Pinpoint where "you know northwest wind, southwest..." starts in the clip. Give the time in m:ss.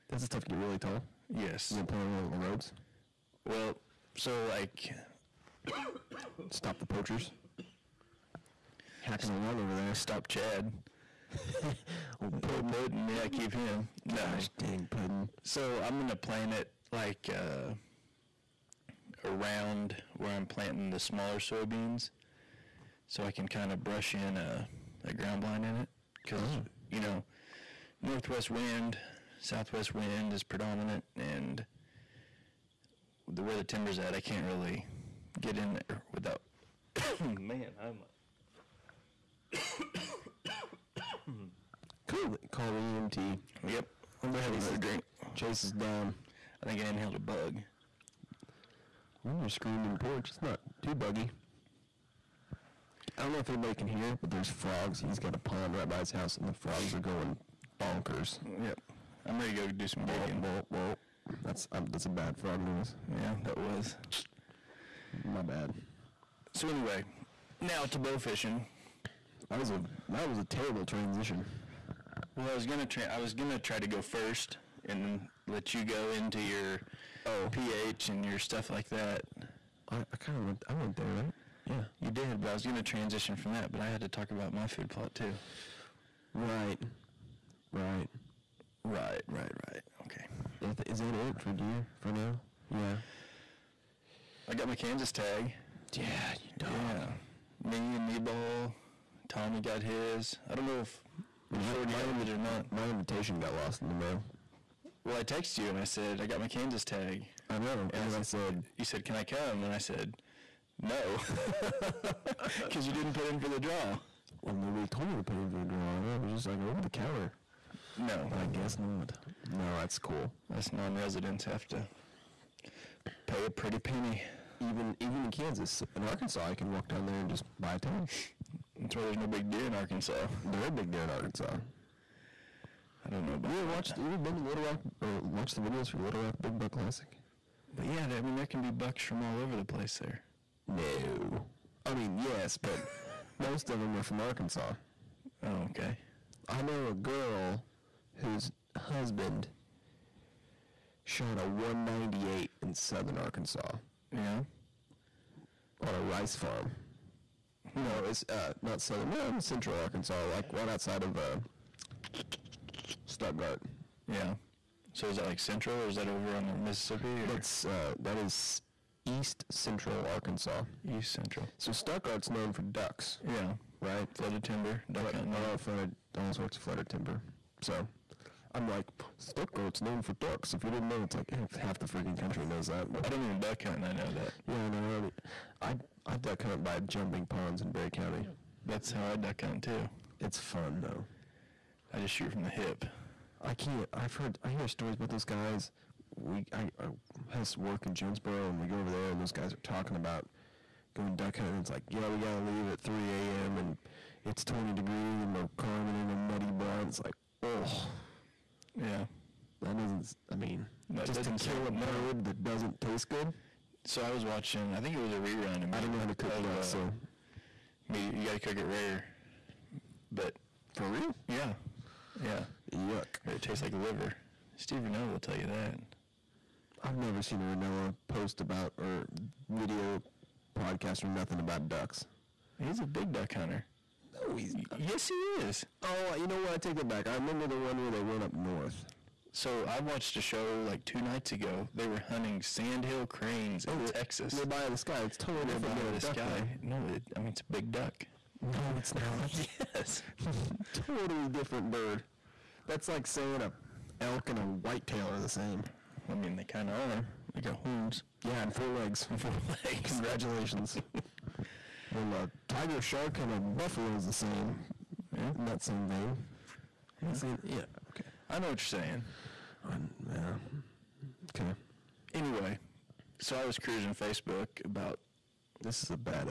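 0:26.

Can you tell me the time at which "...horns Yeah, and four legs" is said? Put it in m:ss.
4:17.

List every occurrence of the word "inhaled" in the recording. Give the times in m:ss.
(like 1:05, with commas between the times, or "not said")
0:46.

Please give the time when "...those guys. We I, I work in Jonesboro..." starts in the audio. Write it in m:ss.
3:15.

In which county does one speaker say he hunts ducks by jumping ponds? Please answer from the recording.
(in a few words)
Barry County.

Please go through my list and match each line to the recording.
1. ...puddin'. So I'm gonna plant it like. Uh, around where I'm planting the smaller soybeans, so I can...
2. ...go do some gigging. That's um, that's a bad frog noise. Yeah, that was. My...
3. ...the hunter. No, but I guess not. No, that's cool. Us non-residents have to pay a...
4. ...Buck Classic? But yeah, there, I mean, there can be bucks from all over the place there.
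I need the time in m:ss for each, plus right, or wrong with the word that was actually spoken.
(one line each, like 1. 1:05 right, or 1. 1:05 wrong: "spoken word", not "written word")
1. 0:14 right
2. 0:59 right
3. 1:56 wrong: "counter", not "hunter"
4. 2:16 right.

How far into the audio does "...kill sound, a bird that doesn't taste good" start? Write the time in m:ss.
3:31.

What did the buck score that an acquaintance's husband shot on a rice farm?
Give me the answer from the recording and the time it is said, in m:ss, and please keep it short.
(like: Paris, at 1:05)
198, at 2:31.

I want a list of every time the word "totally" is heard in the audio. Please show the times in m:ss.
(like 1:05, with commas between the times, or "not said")
4:05, 4:10.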